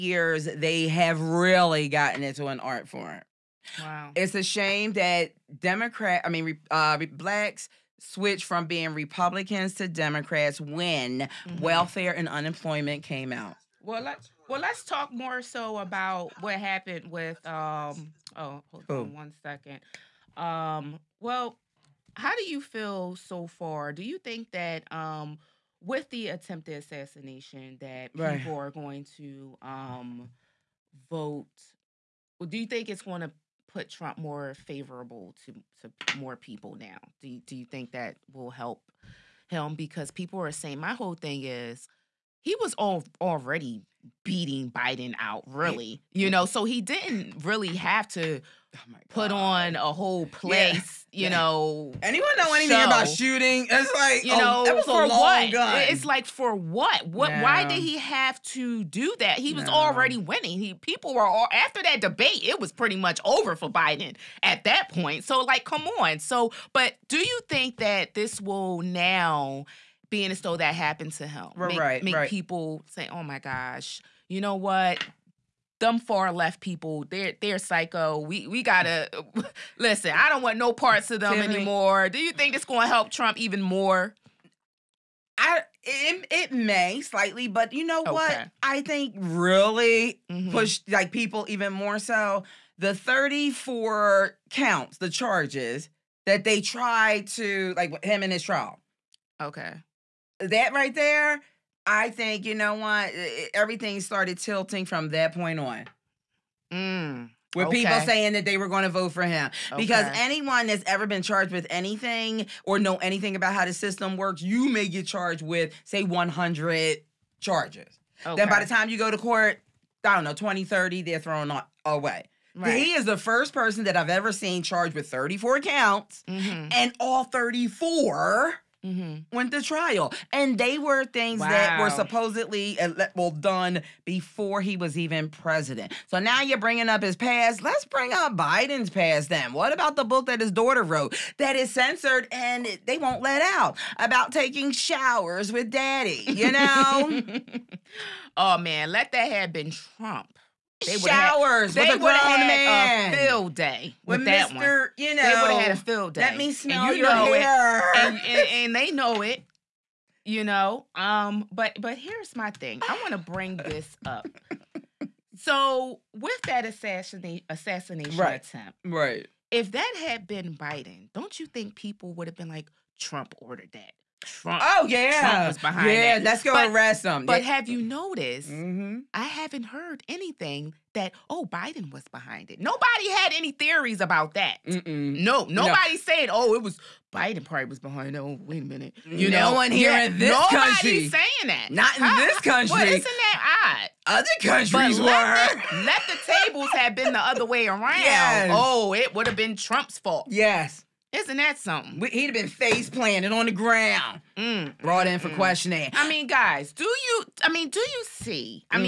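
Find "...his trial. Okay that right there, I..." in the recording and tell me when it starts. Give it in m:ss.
1:38.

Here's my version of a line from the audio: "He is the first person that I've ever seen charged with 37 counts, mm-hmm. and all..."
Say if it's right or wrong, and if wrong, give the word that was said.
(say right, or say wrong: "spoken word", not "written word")
wrong: "34", not "37".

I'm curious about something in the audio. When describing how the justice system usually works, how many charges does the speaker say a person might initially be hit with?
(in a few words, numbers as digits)
100.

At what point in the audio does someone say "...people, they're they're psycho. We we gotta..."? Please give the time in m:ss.
1:16.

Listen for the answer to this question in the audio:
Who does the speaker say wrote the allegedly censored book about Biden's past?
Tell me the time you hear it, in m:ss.
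2:20.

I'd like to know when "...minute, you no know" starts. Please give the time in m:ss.
3:08.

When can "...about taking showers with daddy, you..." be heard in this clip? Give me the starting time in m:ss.
2:23.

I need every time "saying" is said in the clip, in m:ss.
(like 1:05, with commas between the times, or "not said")
0:40, 1:48, 3:11.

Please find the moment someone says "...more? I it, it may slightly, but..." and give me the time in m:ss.
1:23.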